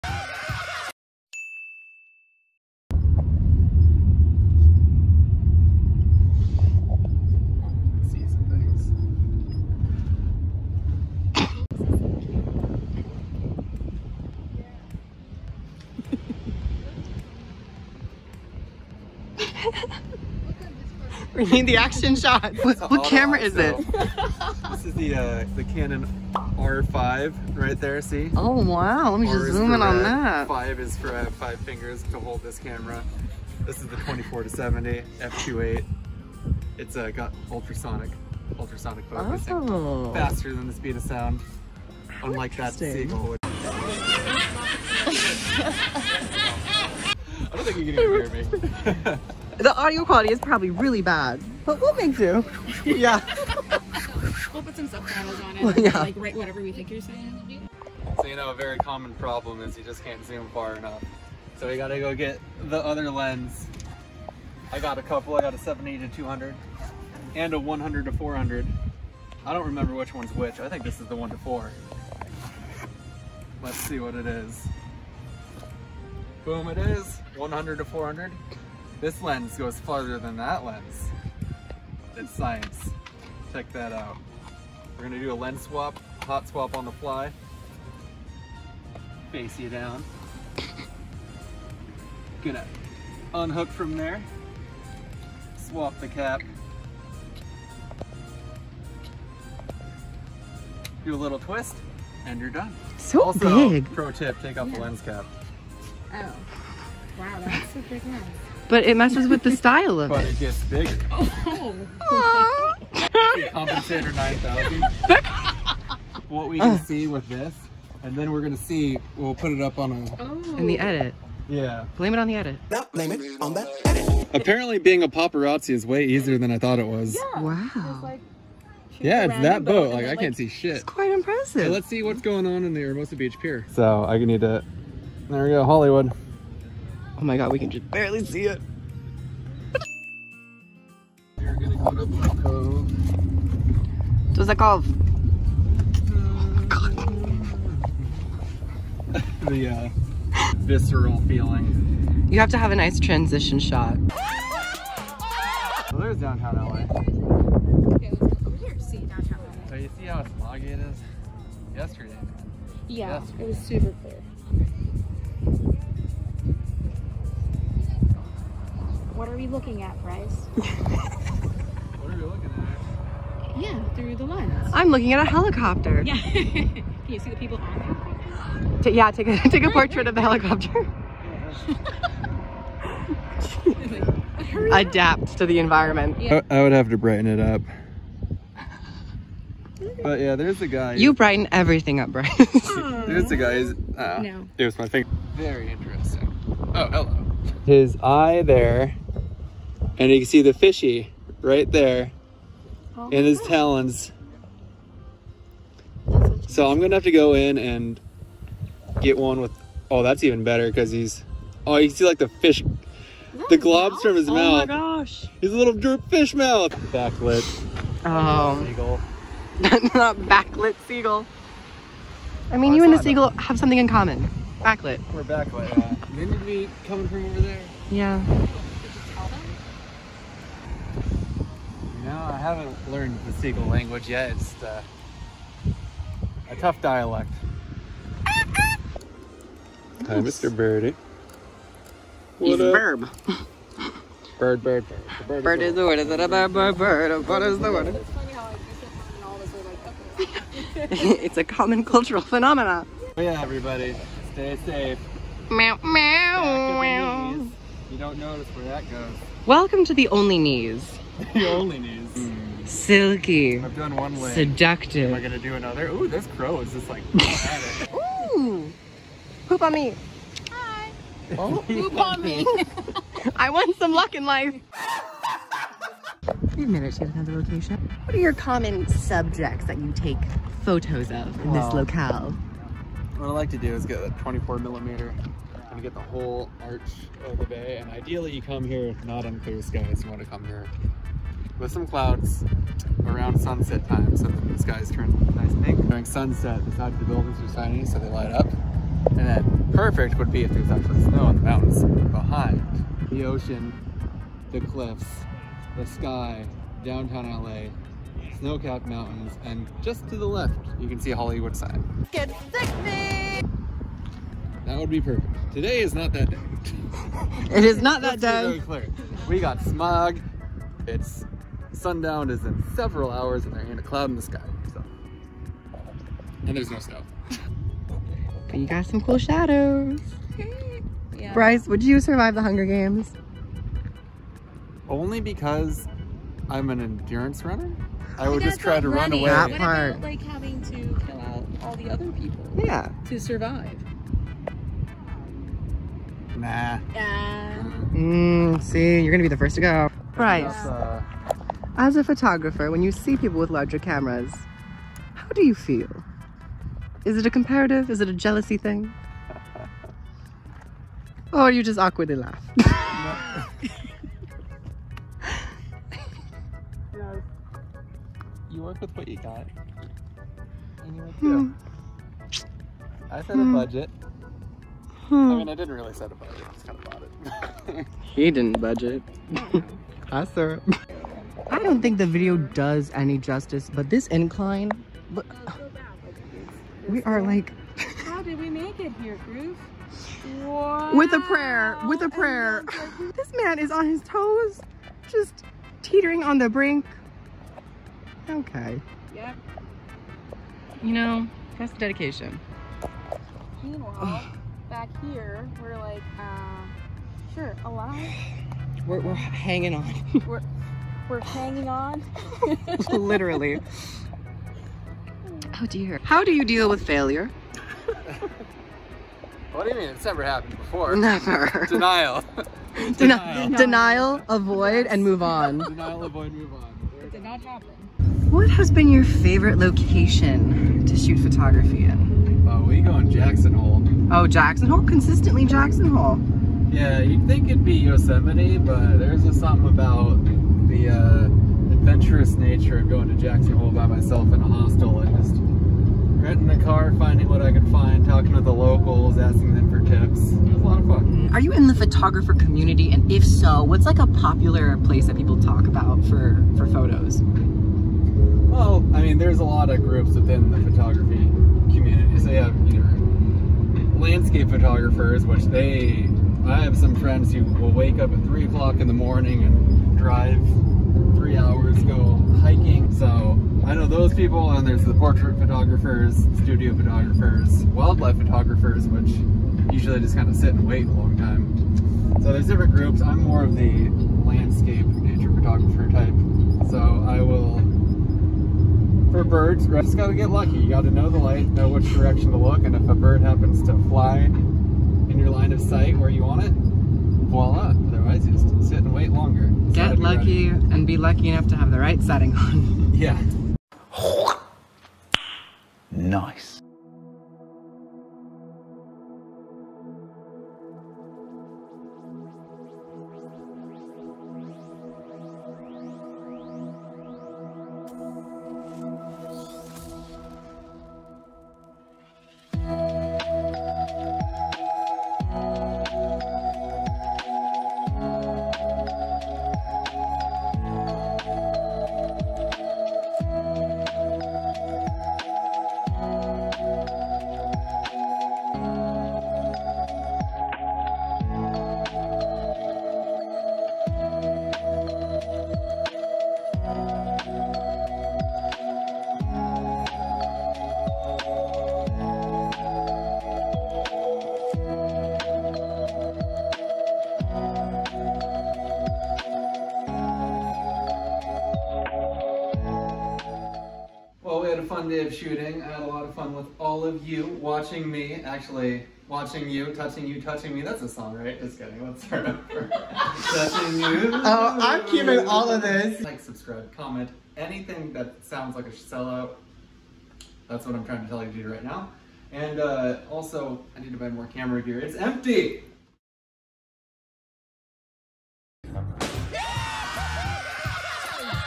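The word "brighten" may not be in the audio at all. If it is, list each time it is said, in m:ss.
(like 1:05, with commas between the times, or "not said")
3:06, 3:11.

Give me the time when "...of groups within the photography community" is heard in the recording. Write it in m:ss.
7:39.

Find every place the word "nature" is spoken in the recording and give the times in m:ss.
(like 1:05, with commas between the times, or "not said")
7:22, 8:04.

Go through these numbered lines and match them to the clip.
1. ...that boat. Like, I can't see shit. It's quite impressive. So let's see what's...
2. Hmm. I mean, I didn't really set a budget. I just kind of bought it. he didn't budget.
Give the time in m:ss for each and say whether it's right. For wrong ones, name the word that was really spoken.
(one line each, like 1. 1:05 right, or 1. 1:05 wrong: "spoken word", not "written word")
1. 2:09 right
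2. 6:15 right.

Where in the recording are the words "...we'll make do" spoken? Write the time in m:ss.
0:51.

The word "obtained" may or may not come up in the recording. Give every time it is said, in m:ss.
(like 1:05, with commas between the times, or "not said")
not said.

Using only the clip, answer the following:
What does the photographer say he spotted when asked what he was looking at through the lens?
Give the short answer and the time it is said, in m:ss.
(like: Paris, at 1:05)
A helicopter, at 2:55.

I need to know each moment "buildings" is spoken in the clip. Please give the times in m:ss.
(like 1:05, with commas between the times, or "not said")
4:57.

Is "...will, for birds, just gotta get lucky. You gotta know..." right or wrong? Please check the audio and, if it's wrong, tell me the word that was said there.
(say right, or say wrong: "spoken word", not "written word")
right.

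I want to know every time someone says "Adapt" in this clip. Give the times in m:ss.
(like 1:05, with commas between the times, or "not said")
3:04.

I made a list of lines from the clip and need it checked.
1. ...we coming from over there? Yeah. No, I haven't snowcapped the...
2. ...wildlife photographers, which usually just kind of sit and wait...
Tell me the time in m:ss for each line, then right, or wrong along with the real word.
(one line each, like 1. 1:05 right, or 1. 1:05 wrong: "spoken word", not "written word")
1. 3:46 wrong: "learned", not "snowcapped"
2. 7:57 right.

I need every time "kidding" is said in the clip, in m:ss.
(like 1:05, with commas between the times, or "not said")
9:31.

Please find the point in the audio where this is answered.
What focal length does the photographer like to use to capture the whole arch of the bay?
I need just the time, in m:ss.
4:44.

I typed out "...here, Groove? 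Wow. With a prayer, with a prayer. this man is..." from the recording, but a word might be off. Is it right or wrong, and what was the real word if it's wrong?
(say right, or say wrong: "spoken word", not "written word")
right.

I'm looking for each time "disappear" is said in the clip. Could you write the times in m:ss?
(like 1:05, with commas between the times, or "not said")
not said.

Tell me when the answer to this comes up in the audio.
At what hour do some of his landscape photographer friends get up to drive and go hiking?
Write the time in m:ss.
7:48.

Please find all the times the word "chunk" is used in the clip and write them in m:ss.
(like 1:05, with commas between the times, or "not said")
not said.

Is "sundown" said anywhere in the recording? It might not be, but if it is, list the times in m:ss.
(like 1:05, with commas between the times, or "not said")
5:21.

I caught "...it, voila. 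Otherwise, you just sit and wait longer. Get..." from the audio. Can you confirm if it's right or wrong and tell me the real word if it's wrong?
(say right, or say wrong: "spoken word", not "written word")
right.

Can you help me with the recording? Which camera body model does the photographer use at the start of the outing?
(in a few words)
Canon R5.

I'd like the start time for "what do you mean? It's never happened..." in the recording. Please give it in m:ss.
6:59.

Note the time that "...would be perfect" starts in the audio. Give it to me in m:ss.
5:14.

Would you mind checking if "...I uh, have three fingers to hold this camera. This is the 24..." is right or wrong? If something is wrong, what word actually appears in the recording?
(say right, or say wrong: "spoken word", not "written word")
wrong: "five", not "three".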